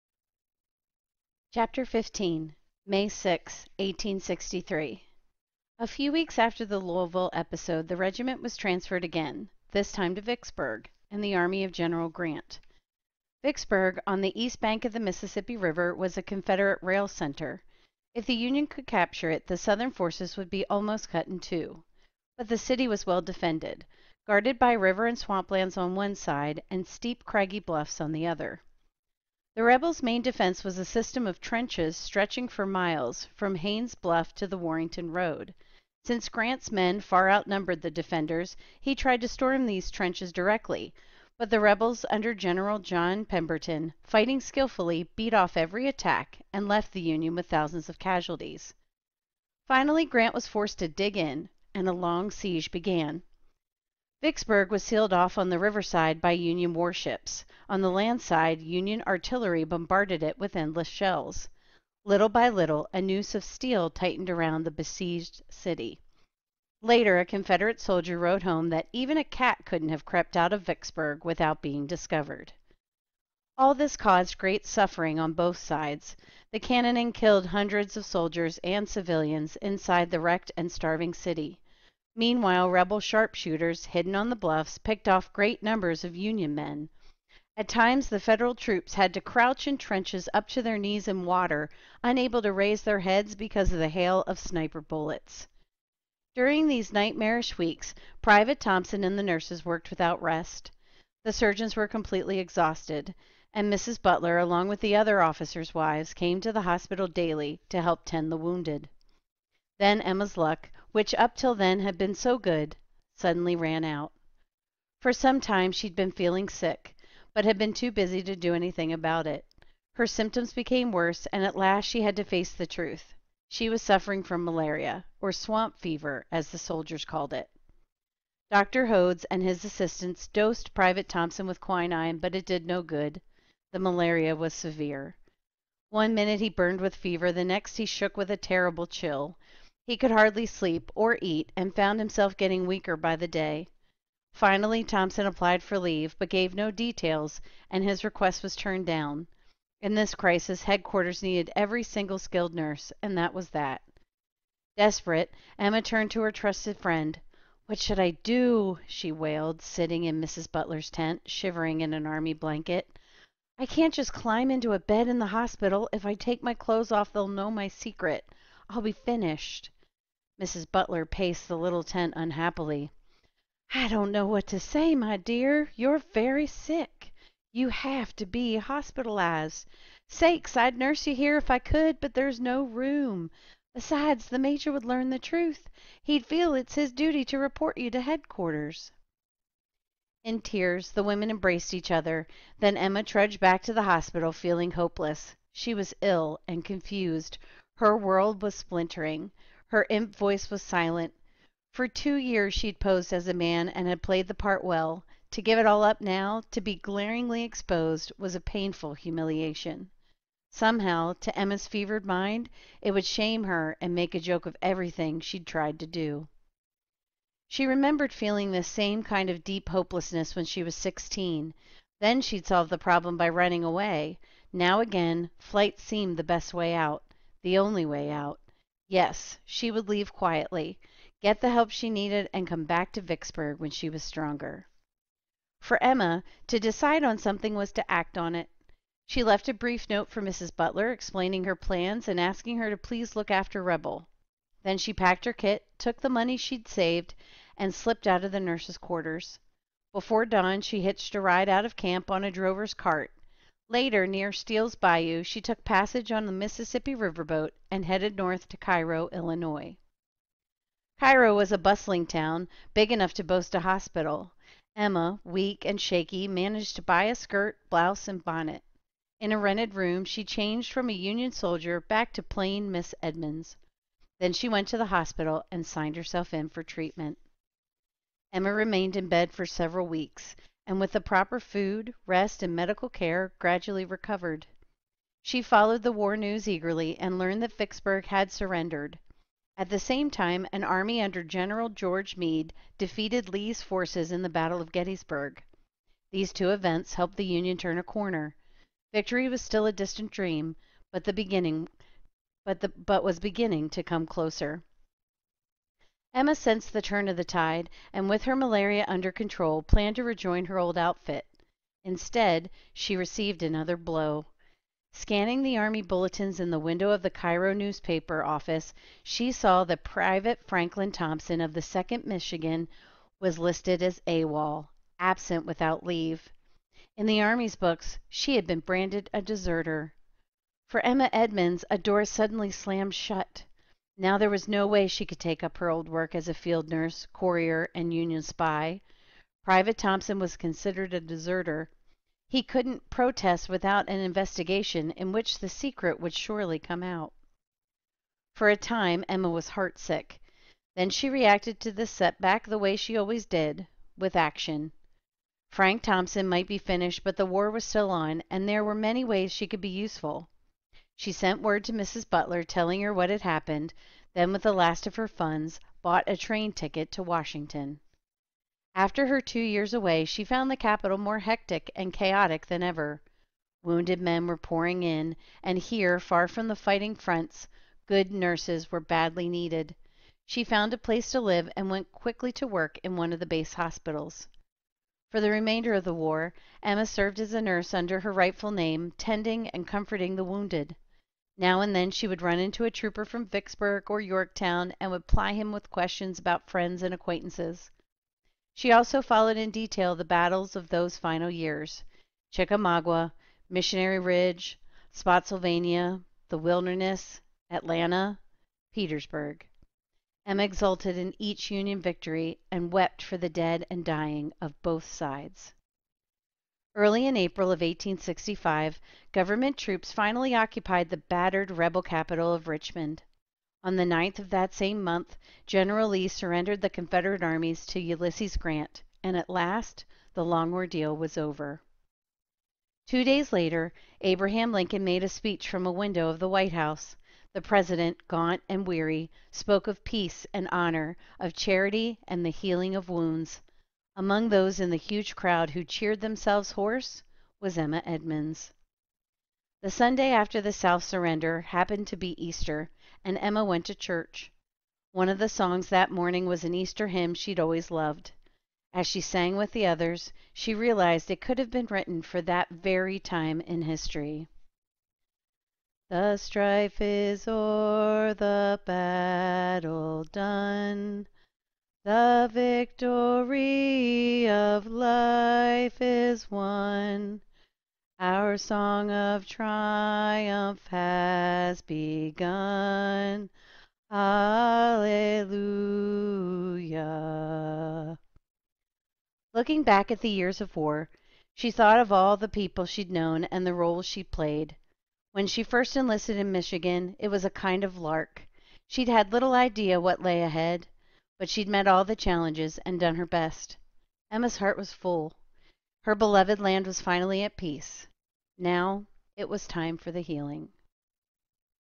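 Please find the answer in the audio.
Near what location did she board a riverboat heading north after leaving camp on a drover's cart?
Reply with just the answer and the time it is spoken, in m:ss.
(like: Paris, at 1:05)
Steele's Bayou, at 4:14.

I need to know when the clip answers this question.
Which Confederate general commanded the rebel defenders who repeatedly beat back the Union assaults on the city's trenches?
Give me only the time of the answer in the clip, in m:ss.
0:42.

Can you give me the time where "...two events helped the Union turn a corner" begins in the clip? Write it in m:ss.
4:56.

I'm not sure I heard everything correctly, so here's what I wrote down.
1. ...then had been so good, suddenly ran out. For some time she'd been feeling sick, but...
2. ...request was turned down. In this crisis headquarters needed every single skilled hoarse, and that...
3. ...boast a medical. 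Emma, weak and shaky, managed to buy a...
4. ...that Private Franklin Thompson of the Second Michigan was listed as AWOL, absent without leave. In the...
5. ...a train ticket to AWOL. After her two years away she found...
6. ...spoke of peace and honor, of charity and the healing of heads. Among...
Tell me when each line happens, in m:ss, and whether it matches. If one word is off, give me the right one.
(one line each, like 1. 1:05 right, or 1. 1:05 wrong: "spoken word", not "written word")
1. 1:51 right
2. 2:28 wrong: "nurse", not "hoarse"
3. 4:23 wrong: "hospital", not "medical"
4. 5:19 right
5. 6:06 wrong: "Washington", not "AWOL"
6. 7:19 wrong: "wounds", not "heads".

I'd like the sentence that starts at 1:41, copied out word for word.
The surgeons were completely exhausted, and Mrs.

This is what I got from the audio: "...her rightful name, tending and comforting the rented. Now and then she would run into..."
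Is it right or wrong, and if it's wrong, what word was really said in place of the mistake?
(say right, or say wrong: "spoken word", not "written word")
wrong: "wounded", not "rented".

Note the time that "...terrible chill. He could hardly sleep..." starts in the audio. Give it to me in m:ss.
2:18.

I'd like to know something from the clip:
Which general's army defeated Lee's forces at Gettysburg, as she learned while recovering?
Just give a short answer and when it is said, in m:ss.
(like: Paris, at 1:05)
George Meade, at 4:51.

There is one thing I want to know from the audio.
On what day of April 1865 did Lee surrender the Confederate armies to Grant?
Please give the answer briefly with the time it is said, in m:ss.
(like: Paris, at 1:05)
9th, at 7:03.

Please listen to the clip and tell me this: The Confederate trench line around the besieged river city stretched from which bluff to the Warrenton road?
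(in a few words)
Haines Bluff.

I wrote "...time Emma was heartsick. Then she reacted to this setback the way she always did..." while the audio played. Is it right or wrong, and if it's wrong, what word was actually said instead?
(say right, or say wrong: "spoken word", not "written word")
right.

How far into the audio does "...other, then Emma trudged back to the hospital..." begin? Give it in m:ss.
3:11.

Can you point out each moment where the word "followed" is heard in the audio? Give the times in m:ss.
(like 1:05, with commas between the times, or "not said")
4:45, 6:39.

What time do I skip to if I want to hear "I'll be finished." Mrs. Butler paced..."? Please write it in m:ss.
2:48.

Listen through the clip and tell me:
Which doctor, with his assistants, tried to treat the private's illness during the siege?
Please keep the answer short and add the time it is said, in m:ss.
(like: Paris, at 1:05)
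Dr. Hodes, at 2:08.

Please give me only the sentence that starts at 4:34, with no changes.
Then she went to the hospital and signed herself in for treatment.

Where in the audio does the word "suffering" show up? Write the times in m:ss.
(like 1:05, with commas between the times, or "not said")
1:14, 2:03.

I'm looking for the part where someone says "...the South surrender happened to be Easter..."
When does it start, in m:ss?
7:30.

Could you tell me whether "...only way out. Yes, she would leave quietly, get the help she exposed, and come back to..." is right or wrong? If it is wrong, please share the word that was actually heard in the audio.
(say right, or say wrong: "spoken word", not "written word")
wrong: "needed", not "exposed".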